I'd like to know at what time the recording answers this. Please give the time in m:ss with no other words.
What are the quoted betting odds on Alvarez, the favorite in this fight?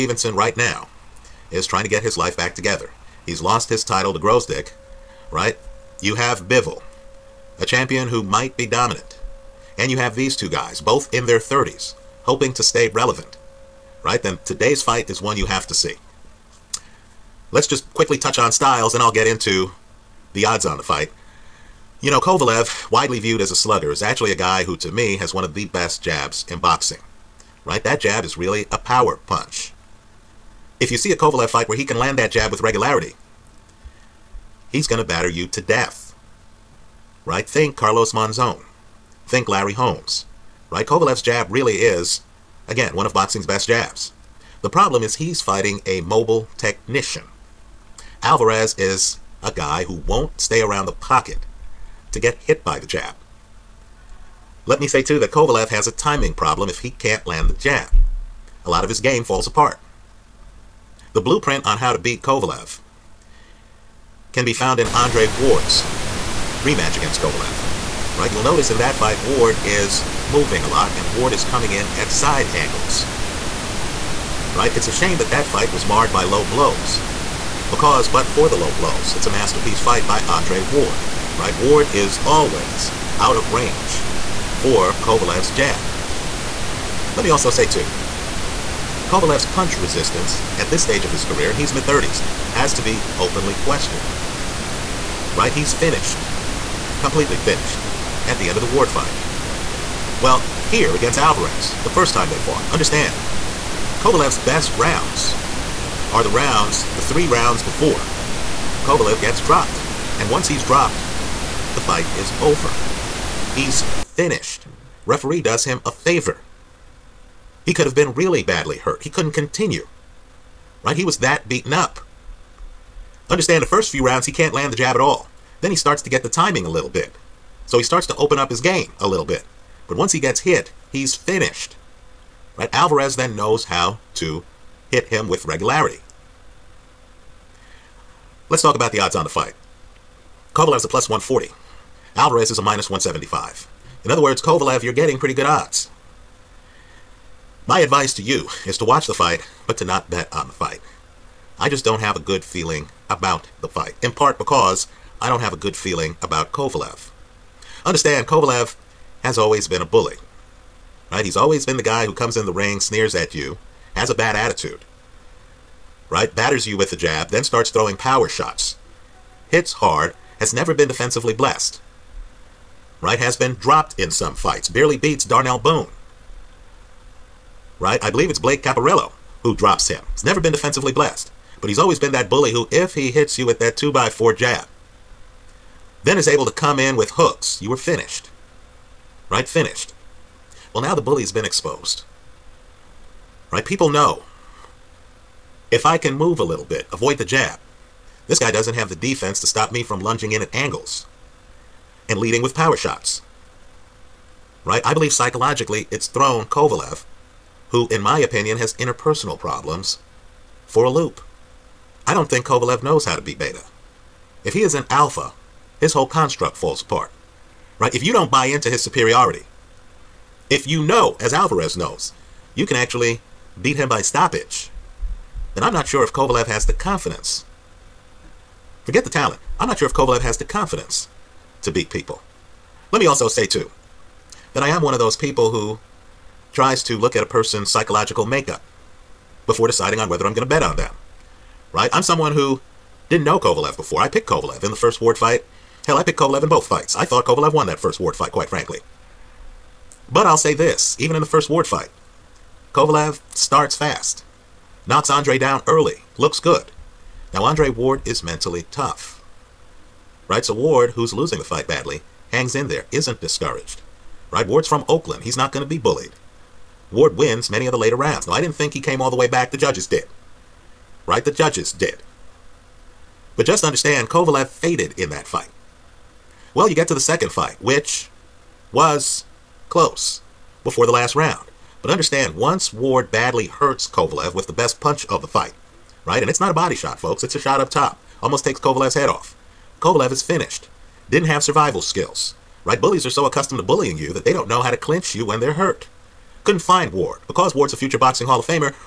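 2:22.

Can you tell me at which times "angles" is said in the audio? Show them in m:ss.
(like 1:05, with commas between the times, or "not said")
1:12, 3:20.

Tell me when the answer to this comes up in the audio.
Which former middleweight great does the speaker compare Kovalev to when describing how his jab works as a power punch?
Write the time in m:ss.
0:37.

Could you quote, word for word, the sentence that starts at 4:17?
Now, Andre Ward is mentally tough.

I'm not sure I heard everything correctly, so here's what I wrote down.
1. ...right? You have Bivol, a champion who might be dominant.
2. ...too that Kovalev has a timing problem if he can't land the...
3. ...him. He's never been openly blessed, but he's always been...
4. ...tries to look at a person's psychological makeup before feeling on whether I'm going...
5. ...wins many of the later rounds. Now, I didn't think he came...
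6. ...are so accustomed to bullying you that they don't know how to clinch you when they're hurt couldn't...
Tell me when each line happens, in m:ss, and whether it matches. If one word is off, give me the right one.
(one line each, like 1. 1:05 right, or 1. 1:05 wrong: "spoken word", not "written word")
1. 0:05 right
2. 0:55 right
3. 2:59 wrong: "defensively", not "openly"
4. 3:56 wrong: "deciding", not "feeling"
5. 4:27 right
6. 4:53 right.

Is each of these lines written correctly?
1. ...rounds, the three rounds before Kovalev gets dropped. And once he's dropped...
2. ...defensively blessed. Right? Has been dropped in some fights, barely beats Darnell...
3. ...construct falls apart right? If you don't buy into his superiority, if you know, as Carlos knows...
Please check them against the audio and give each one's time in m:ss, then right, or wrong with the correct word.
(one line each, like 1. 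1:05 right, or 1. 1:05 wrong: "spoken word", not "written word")
1. 1:46 right
2. 2:50 right
3. 3:36 wrong: "Alvarez", not "Carlos".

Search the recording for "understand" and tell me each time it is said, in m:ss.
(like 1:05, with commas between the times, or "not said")
1:42, 2:03, 2:37, 4:33, 4:41.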